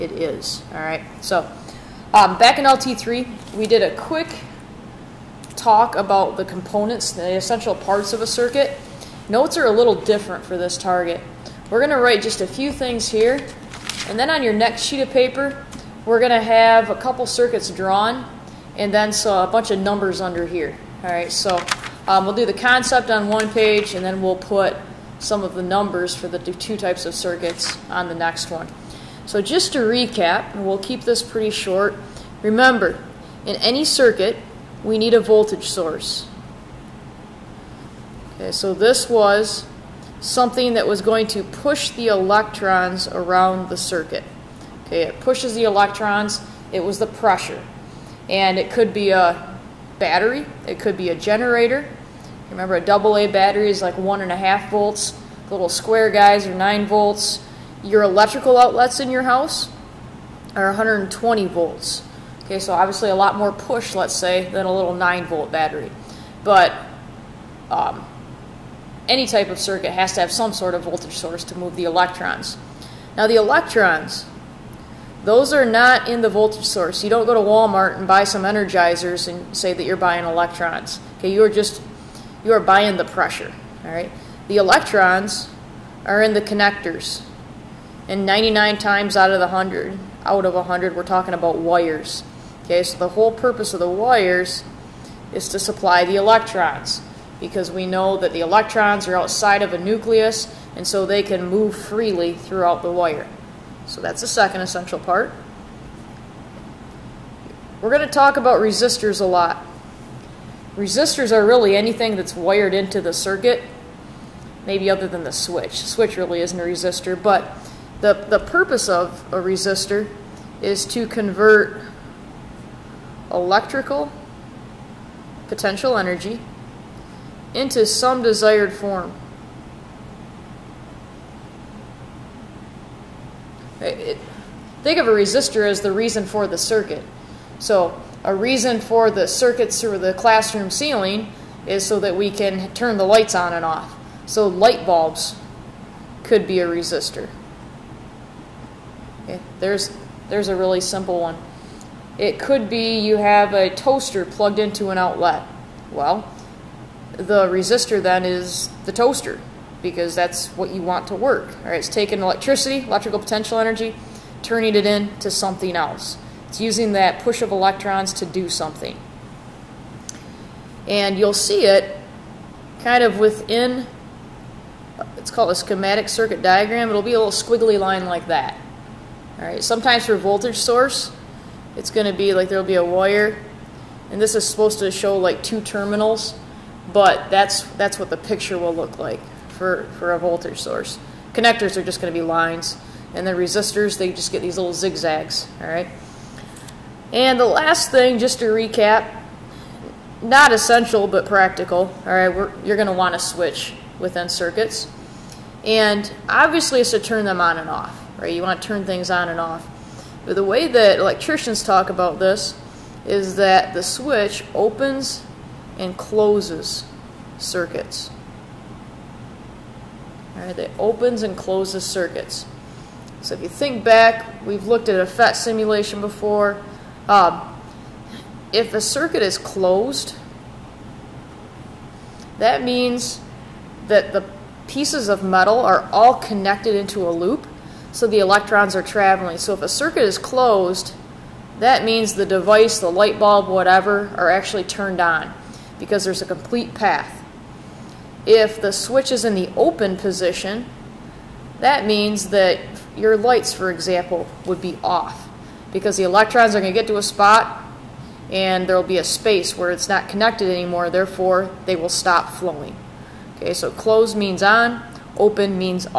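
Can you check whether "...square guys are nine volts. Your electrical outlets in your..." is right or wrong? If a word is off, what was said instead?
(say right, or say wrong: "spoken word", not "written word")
right.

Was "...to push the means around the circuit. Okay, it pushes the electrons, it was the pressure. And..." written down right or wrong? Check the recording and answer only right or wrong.
wrong.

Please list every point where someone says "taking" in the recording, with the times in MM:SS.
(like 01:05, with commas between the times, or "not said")
02:41.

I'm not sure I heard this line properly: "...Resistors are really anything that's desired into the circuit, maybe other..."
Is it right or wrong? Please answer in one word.
wrong.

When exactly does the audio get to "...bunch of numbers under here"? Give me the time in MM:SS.
00:19.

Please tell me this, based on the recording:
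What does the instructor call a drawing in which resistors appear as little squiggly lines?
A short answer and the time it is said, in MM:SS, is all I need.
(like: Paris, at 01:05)
schematic circuit diagram, at 02:55.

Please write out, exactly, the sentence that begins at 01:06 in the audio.
But um, any type of circuit has to have some sort of voltage source to move the electrons.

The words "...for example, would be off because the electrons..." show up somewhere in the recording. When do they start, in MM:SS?
04:13.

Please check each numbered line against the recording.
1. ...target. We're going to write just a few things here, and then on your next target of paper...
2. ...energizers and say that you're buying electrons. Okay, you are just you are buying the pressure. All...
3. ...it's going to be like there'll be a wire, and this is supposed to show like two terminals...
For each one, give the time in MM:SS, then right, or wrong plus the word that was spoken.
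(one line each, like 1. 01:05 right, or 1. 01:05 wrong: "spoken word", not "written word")
1. 00:10 wrong: "sheet", not "target"
2. 01:18 right
3. 03:01 right.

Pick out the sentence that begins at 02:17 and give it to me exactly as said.
So a reason for the circuits through the classroom ceiling is so that we can turn the lights on and off.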